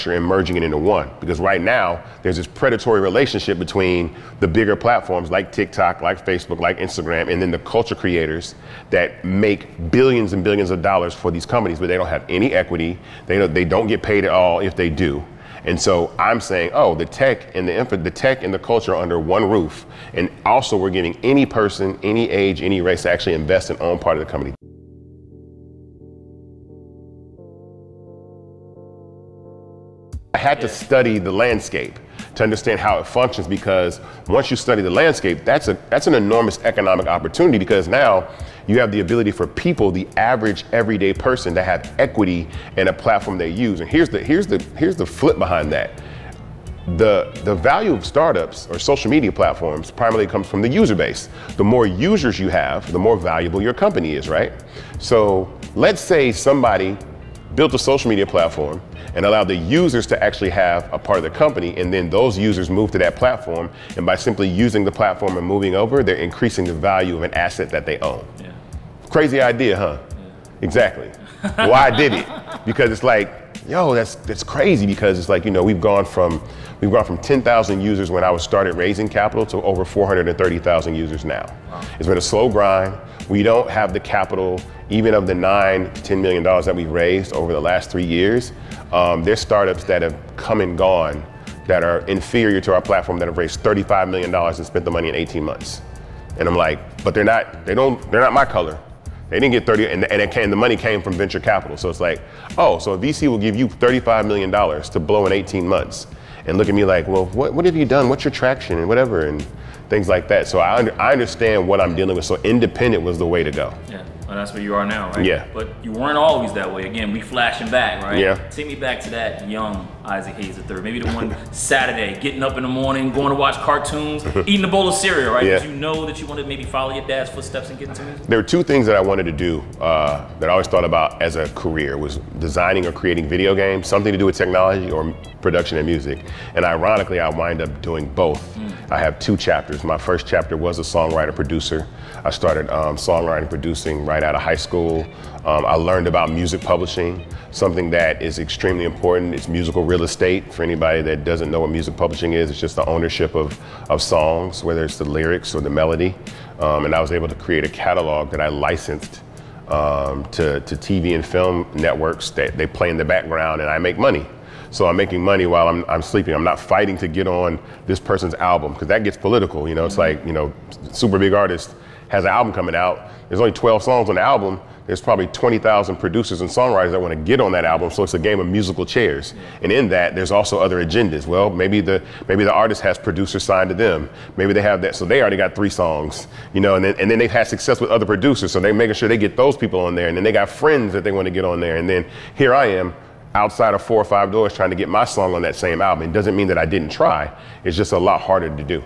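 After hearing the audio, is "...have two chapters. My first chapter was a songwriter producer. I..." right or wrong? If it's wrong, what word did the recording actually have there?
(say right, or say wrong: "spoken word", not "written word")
right.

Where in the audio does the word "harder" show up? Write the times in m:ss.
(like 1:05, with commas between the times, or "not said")
3:18.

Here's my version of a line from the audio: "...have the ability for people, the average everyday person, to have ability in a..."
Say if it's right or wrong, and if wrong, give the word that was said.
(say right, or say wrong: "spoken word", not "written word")
wrong: "equity", not "ability".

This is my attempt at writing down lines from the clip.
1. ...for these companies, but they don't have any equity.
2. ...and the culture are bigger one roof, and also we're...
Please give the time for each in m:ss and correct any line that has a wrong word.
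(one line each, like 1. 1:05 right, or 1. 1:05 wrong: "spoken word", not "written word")
1. 0:11 right
2. 0:18 wrong: "under", not "bigger".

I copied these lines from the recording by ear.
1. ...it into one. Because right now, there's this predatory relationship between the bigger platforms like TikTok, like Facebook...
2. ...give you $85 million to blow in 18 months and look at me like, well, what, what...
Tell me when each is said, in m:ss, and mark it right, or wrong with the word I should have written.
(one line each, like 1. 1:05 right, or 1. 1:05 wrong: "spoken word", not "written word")
1. 0:00 right
2. 1:43 wrong: "35", not "85".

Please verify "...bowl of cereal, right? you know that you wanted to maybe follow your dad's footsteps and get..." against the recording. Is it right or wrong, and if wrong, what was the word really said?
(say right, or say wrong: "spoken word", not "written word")
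right.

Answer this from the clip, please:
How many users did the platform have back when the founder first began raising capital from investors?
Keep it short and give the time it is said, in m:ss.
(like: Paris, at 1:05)
10,000, at 1:17.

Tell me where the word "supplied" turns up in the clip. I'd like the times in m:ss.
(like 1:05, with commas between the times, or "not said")
not said.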